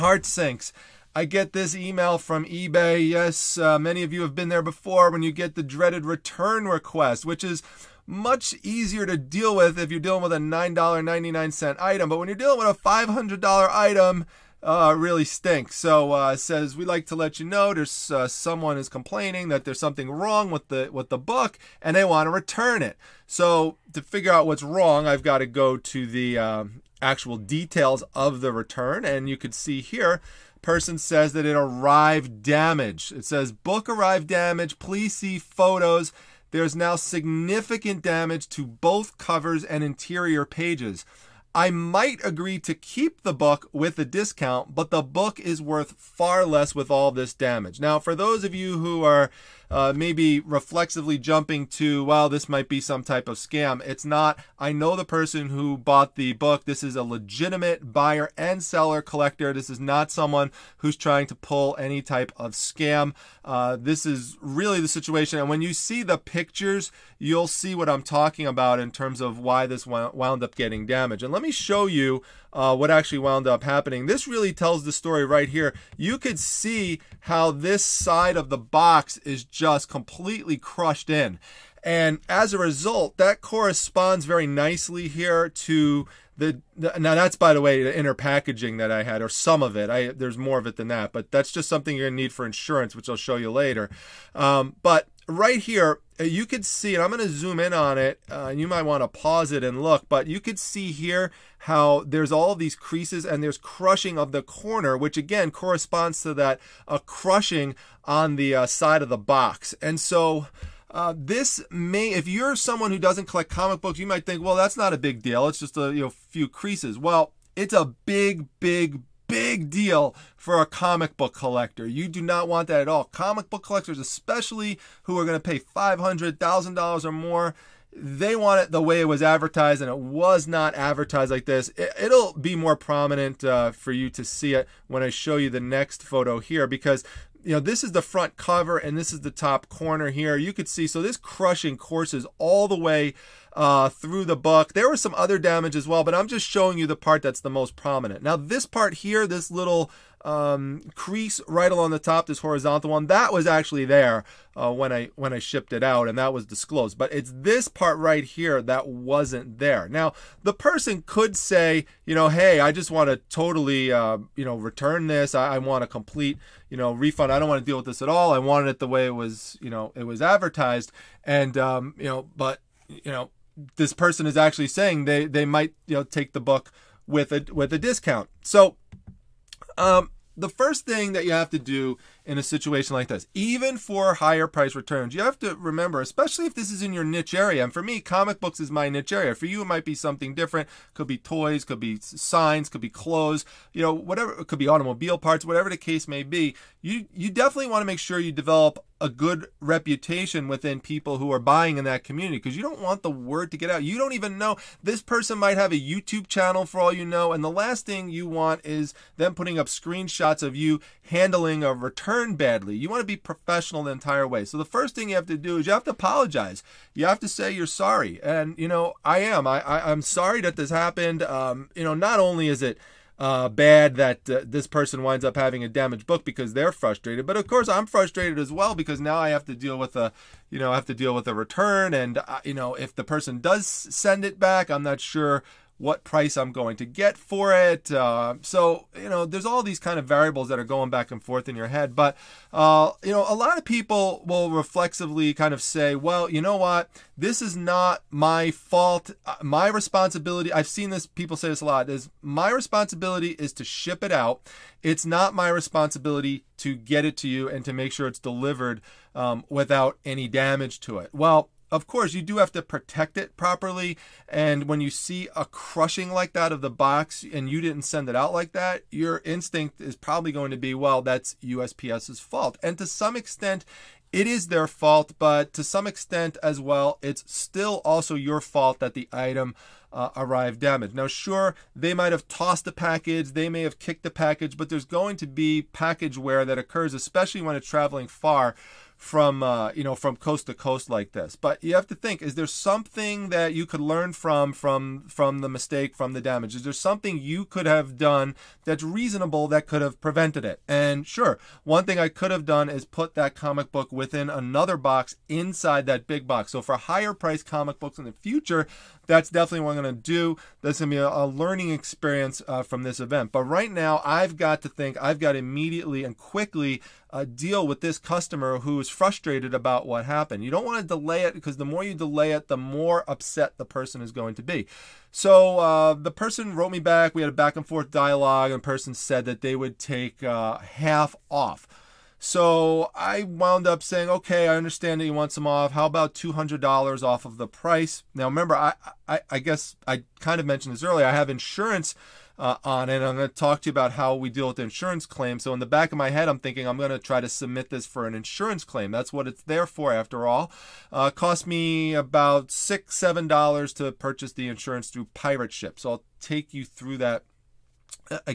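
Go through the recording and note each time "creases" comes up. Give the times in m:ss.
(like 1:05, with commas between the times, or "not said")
1:42, 1:56, 2:30.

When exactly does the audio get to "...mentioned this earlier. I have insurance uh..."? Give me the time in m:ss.
5:40.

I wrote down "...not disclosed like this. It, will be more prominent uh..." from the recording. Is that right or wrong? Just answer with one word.
wrong.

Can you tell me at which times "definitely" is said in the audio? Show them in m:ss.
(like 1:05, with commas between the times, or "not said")
3:17, 5:09.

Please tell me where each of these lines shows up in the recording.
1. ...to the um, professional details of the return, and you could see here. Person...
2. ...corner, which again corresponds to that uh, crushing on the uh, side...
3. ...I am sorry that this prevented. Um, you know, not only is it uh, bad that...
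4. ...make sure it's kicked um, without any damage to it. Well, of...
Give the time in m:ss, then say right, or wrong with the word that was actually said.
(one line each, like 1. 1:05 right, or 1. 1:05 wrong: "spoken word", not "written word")
1. 0:25 wrong: "actual", not "professional"
2. 1:44 right
3. 3:39 wrong: "happened", not "prevented"
4. 4:17 wrong: "delivered", not "kicked".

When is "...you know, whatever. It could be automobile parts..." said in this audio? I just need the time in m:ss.
3:13.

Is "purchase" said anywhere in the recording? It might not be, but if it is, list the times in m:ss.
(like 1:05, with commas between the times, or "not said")
5:53.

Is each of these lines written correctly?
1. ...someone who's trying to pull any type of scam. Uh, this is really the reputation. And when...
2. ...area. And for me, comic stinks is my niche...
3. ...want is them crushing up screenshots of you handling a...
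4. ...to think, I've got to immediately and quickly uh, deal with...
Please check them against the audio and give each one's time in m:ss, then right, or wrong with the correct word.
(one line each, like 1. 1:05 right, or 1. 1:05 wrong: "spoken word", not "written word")
1. 1:00 wrong: "situation", not "reputation"
2. 3:07 wrong: "books", not "stinks"
3. 3:28 wrong: "putting", not "crushing"
4. 5:14 right.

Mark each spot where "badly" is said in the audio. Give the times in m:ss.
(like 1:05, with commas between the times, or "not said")
3:32.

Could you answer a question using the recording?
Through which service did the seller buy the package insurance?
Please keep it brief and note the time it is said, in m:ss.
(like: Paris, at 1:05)
Pirate Ship, at 5:55.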